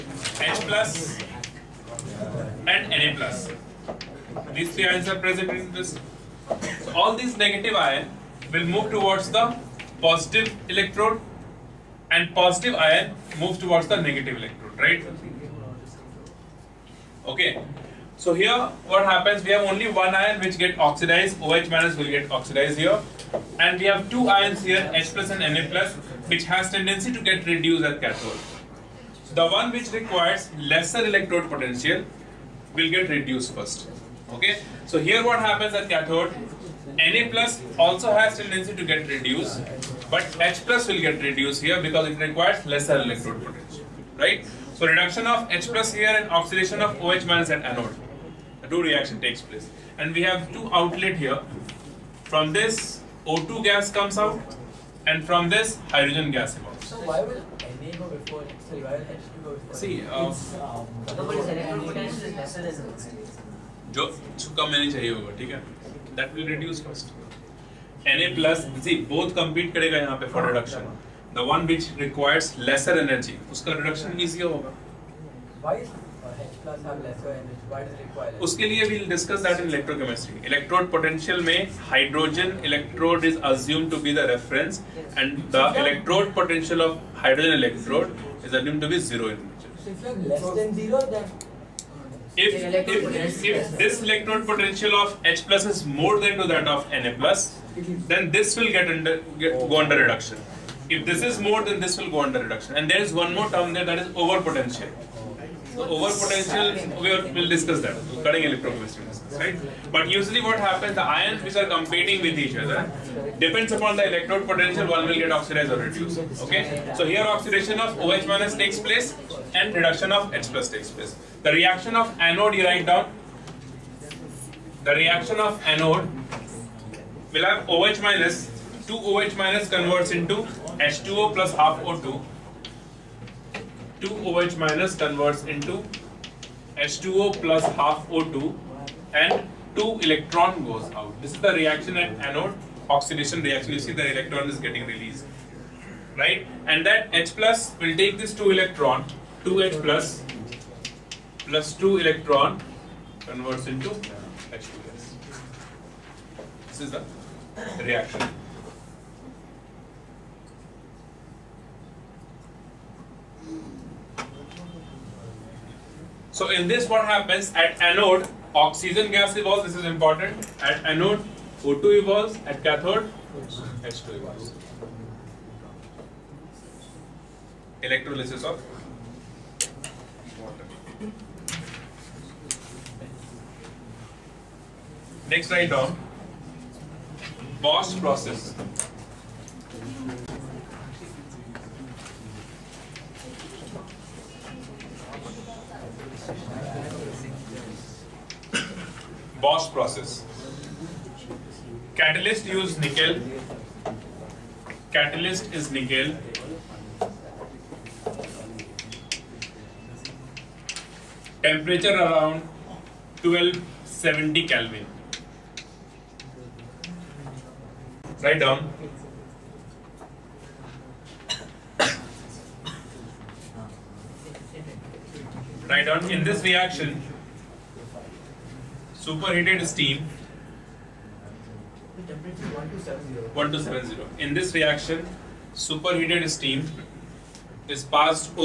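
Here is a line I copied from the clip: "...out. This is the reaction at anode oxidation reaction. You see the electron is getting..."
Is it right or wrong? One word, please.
right.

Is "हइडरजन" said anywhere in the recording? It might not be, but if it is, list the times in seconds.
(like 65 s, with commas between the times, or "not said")
81 s, 87 s.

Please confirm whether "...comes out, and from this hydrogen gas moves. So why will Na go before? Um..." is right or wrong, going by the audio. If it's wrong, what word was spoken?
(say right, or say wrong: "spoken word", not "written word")
wrong: "evolves", not "moves".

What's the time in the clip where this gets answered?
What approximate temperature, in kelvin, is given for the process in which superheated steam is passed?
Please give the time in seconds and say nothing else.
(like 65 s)
213 s.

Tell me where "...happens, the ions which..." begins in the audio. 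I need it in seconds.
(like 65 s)
110 s.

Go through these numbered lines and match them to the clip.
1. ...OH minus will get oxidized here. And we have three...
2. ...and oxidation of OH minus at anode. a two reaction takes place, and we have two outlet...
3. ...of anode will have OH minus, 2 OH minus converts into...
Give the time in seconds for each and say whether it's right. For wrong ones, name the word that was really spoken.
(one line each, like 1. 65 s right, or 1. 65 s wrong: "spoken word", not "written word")
1. 21 s wrong: "two", not "three"
2. 46 s right
3. 125 s right.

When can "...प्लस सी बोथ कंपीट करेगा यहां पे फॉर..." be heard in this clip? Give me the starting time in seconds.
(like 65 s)
68 s.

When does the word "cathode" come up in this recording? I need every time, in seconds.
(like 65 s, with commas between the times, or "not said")
28 s, 35 s, 172 s.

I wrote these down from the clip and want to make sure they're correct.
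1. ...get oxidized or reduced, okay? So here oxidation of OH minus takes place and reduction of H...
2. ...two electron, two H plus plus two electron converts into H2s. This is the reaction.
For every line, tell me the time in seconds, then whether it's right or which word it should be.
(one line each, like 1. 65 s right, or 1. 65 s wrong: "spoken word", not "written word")
1. 115 s right
2. 148 s right.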